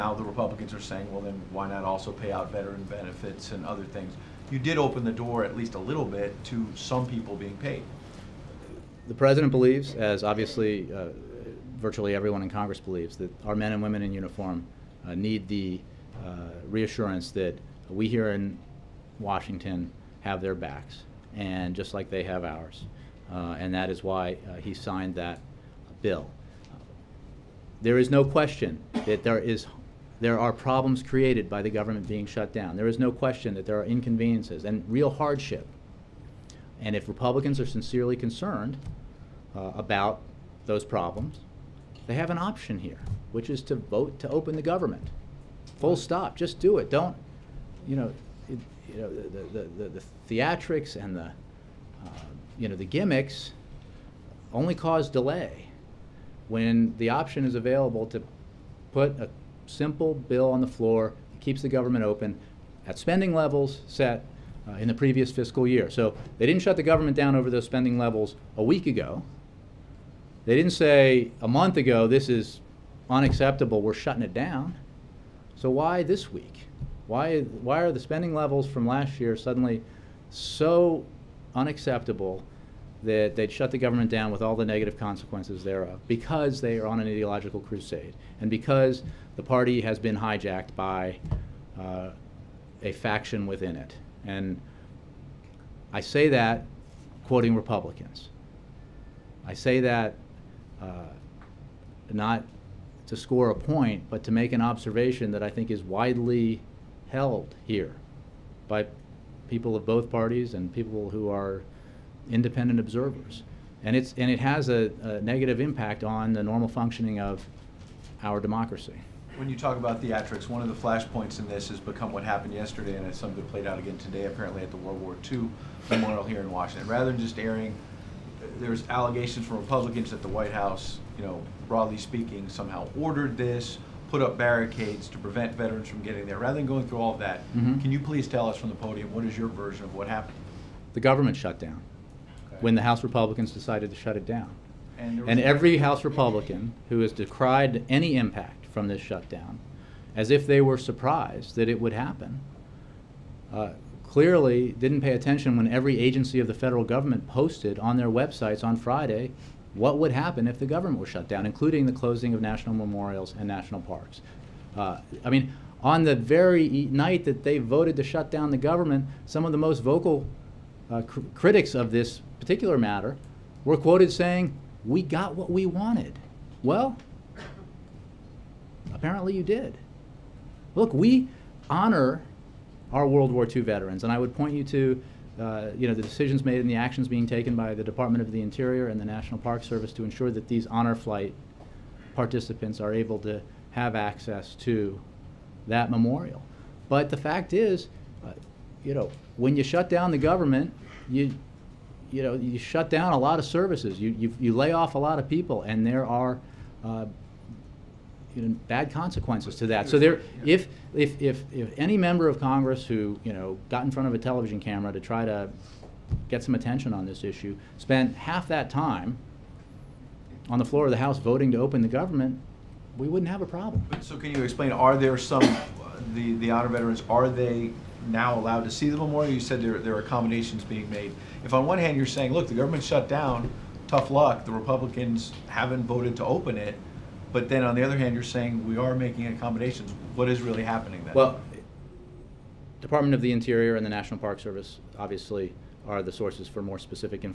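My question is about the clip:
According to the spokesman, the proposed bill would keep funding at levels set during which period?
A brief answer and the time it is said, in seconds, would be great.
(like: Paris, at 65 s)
previous fiscal year, at 64 s.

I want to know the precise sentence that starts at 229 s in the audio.
You said there, there are accommodations being made.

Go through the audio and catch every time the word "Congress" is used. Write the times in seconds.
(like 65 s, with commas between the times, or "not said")
12 s, 212 s.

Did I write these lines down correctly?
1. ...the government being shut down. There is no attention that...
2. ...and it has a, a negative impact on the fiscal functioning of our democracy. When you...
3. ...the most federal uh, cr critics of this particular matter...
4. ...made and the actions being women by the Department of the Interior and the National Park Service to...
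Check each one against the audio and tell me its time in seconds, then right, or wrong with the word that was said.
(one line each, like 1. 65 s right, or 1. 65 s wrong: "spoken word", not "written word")
1. 31 s wrong: "question", not "attention"
2. 114 s wrong: "normal", not "fiscal"
3. 169 s wrong: "vocal", not "federal"
4. 186 s wrong: "taken", not "women".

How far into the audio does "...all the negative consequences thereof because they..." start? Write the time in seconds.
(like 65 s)
84 s.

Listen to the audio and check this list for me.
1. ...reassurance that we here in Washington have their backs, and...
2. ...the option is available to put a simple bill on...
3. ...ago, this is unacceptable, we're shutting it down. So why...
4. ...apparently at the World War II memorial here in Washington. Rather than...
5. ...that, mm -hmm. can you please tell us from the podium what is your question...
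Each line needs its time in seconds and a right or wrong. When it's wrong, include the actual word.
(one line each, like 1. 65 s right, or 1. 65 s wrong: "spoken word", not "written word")
1. 16 s right
2. 56 s right
3. 71 s right
4. 124 s right
5. 137 s wrong: "version", not "question".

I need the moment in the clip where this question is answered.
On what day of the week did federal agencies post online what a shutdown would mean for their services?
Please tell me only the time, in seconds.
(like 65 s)
158 s.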